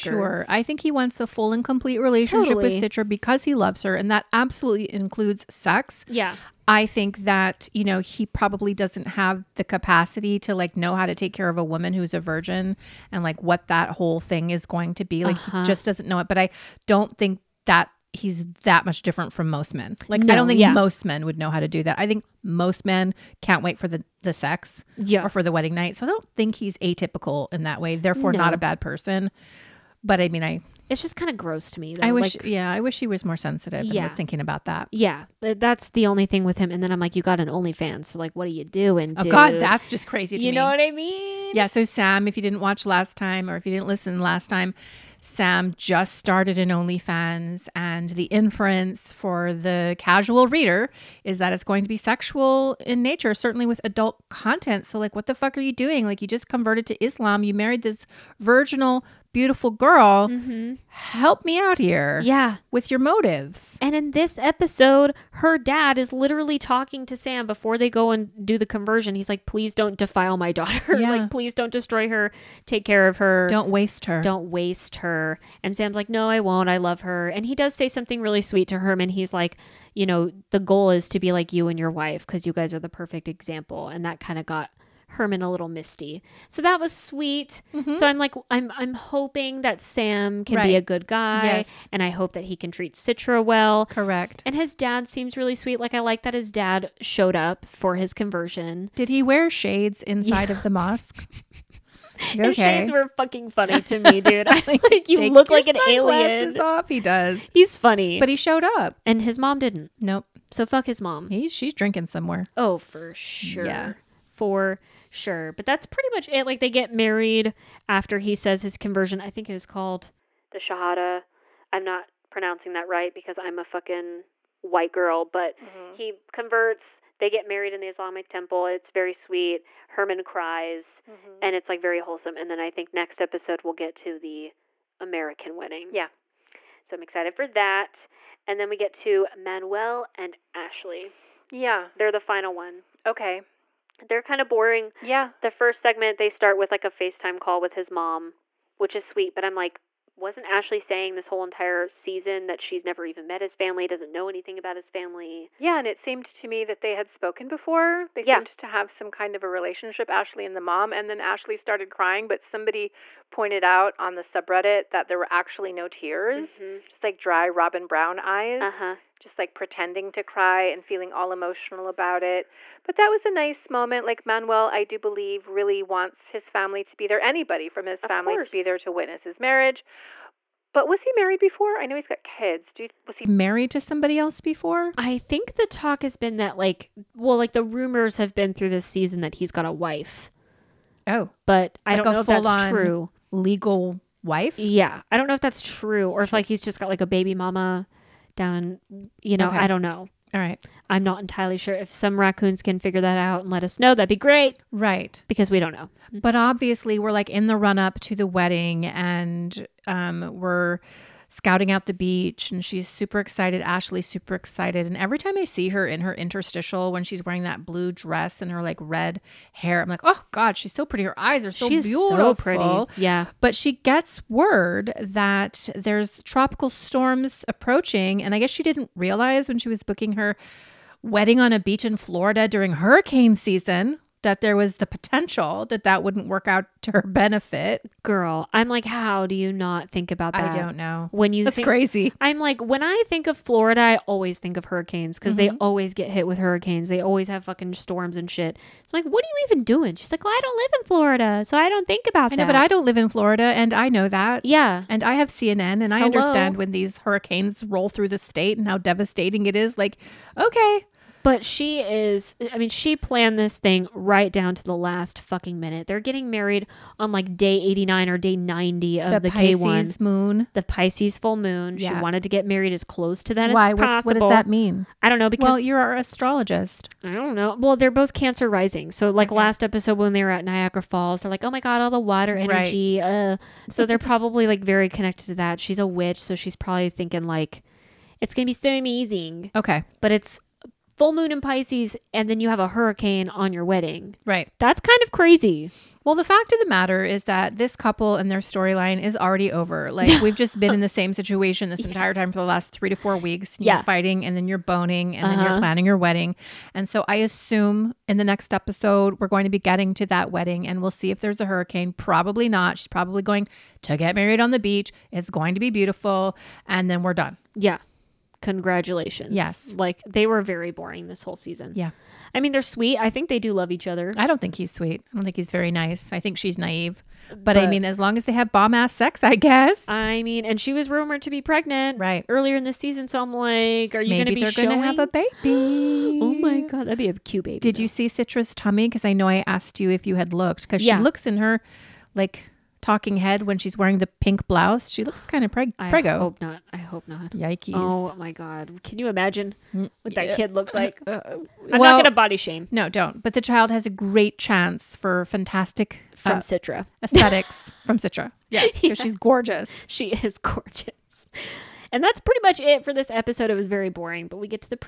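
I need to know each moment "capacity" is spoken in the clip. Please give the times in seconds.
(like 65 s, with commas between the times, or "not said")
9 s.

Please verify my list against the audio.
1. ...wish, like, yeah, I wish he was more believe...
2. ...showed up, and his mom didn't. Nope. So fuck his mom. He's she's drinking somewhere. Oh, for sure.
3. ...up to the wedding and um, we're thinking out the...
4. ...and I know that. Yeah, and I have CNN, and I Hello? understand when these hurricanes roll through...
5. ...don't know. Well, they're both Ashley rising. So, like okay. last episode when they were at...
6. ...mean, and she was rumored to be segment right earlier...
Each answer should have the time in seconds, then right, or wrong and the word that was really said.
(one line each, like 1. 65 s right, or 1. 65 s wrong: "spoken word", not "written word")
1. 32 s wrong: "sensitive", not "believe"
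2. 108 s right
3. 207 s wrong: "scouting", not "thinking"
4. 253 s right
5. 277 s wrong: "Cancer", not "Ashley"
6. 330 s wrong: "pregnant", not "segment".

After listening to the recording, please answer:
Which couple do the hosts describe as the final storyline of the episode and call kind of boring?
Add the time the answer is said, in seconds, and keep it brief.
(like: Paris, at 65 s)
Manuel and Ashley, at 139 s.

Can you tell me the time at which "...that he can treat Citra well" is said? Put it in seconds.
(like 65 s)
92 s.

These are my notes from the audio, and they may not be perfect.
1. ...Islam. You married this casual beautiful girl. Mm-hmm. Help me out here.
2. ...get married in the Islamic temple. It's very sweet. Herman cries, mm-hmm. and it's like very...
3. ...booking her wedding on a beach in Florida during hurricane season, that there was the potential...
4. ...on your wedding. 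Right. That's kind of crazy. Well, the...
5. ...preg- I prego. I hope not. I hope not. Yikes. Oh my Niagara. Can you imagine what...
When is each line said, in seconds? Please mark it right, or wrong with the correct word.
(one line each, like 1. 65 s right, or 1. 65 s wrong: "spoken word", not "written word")
1. 57 s wrong: "virginal", not "casual"
2. 127 s right
3. 229 s right
4. 293 s right
5. 345 s wrong: "God", not "Niagara".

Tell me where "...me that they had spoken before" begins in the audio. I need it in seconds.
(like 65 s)
156 s.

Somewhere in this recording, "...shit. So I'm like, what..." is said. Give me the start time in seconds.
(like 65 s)
248 s.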